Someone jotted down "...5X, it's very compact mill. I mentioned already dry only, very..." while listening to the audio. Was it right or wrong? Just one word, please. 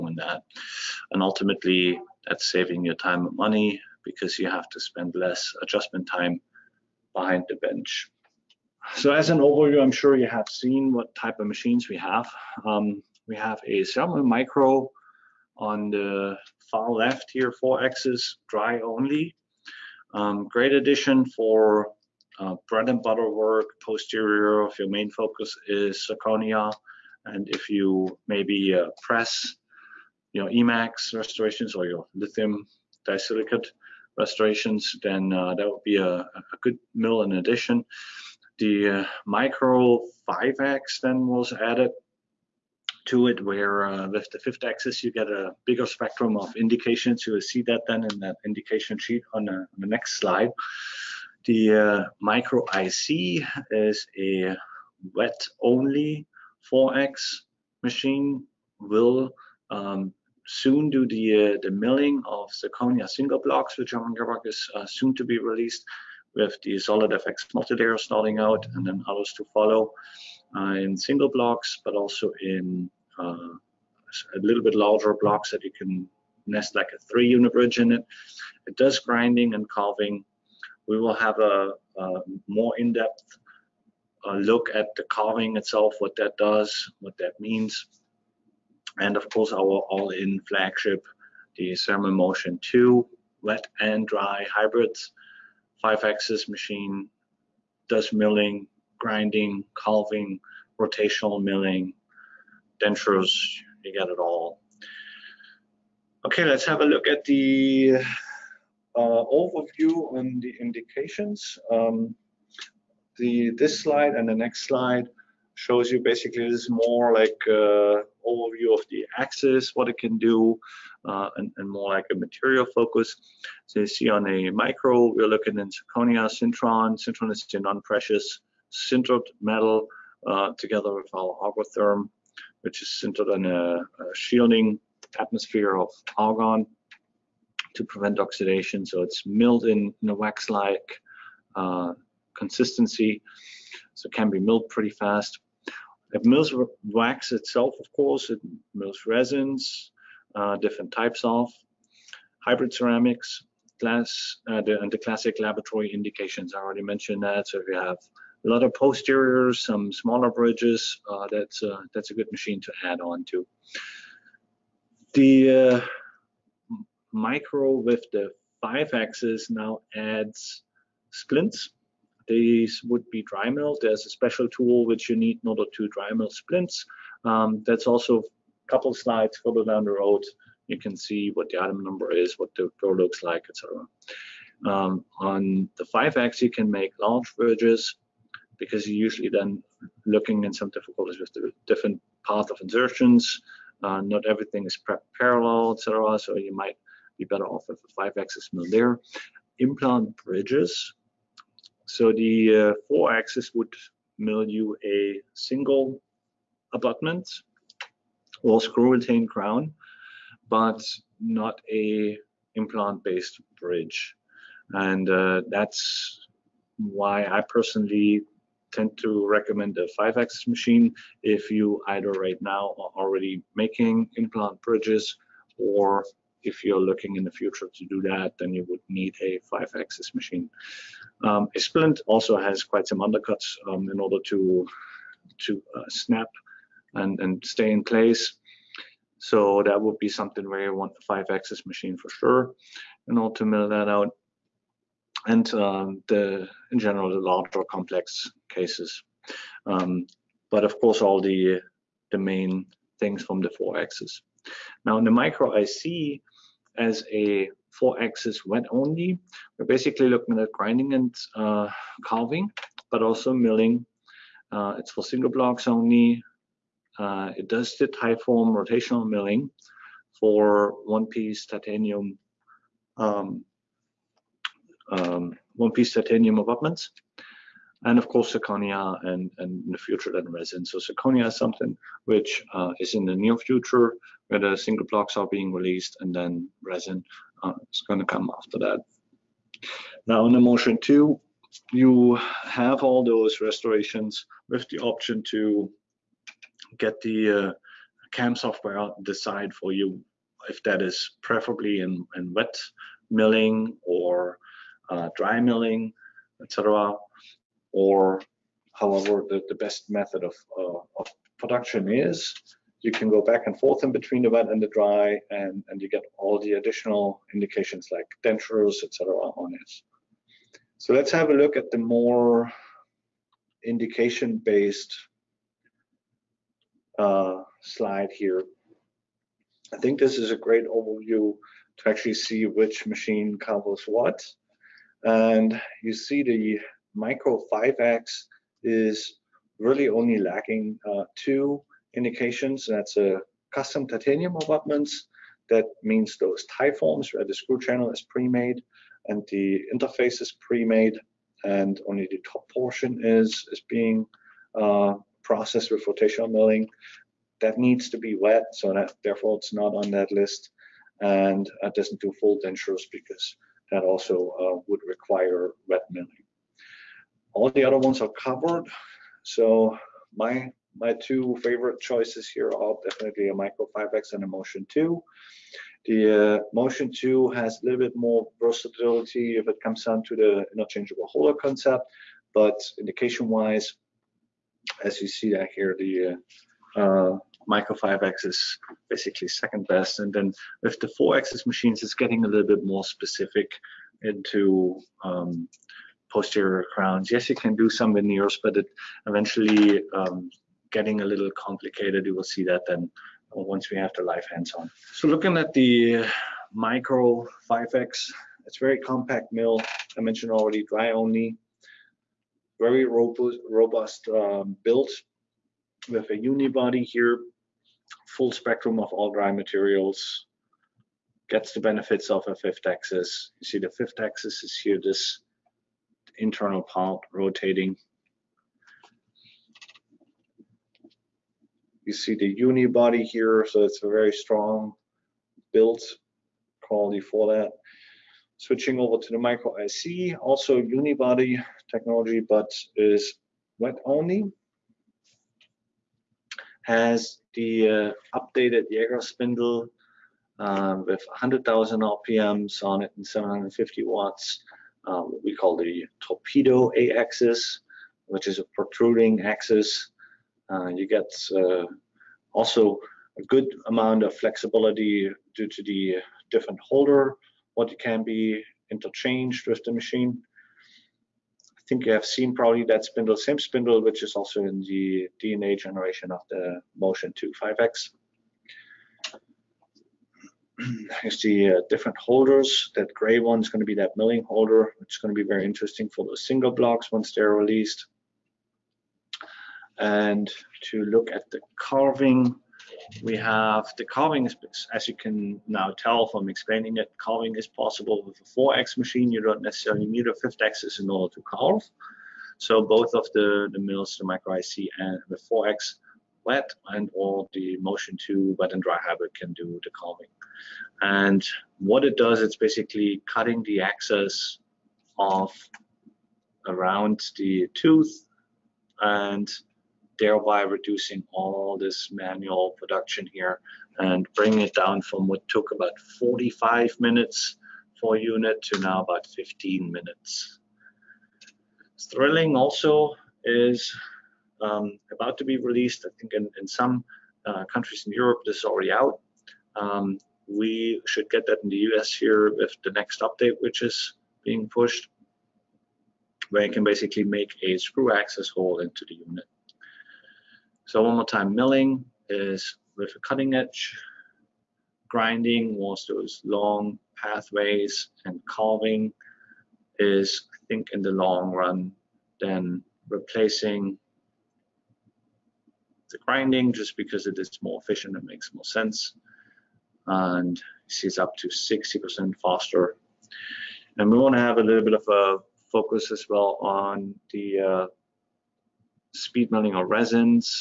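right.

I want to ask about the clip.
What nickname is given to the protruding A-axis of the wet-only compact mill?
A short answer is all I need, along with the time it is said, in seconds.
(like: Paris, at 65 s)
torpedo, at 456 s.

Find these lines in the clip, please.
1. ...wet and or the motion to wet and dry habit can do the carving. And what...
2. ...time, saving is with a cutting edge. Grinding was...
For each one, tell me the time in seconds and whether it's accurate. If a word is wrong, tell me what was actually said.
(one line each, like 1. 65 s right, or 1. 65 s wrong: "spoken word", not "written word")
1. 506 s right
2. 551 s wrong: "milling", not "saving".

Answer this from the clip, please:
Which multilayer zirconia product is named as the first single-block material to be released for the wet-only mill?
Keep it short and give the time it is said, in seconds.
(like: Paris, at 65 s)
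Zolid FX multilayer, at 67 s.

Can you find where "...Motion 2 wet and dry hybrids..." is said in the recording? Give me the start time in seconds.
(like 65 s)
92 s.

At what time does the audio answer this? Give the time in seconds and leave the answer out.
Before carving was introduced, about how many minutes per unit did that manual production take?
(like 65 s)
525 s.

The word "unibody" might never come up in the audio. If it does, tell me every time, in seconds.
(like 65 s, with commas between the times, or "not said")
416 s, 440 s.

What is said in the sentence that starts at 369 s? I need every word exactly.
So my my two favorite choices here are definitely a Micro 5X and a Motion 2.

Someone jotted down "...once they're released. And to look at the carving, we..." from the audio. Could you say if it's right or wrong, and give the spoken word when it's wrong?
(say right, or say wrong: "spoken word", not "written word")
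right.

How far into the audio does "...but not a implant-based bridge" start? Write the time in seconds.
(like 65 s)
210 s.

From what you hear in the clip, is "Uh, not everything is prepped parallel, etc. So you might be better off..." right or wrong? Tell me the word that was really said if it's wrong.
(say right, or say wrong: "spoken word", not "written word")
right.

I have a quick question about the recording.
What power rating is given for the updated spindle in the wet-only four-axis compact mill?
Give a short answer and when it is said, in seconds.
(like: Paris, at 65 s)
750 watts, at 453 s.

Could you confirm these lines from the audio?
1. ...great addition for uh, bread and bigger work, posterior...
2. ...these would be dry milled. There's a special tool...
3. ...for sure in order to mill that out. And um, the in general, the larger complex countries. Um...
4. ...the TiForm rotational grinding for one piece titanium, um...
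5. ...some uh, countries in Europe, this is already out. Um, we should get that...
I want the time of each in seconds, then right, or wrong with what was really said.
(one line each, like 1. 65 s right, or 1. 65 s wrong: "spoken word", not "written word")
1. 20 s wrong: "butter", not "bigger"
2. 172 s right
3. 241 s wrong: "cases", not "countries"
4. 267 s wrong: "milling", not "grinding"
5. 536 s right.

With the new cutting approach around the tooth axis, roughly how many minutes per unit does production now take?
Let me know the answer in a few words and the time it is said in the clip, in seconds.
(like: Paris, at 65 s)
15 minutes, at 529 s.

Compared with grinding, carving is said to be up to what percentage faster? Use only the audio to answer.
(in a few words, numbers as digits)
60%.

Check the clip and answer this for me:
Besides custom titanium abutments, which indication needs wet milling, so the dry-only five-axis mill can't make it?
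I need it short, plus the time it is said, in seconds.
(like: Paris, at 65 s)
full dentures, at 362 s.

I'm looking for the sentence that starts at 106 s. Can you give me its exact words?
Okay, let's have a look at the uh, overview and the indications.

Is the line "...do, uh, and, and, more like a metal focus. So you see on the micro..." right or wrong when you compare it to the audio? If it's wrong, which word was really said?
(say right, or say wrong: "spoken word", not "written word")
wrong: "material", not "metal".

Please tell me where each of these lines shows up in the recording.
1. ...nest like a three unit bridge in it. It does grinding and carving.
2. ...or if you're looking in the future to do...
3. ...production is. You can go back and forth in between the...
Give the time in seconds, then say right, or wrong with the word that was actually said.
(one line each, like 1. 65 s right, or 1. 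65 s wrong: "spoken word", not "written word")
1. 76 s right
2. 225 s right
3. 311 s right.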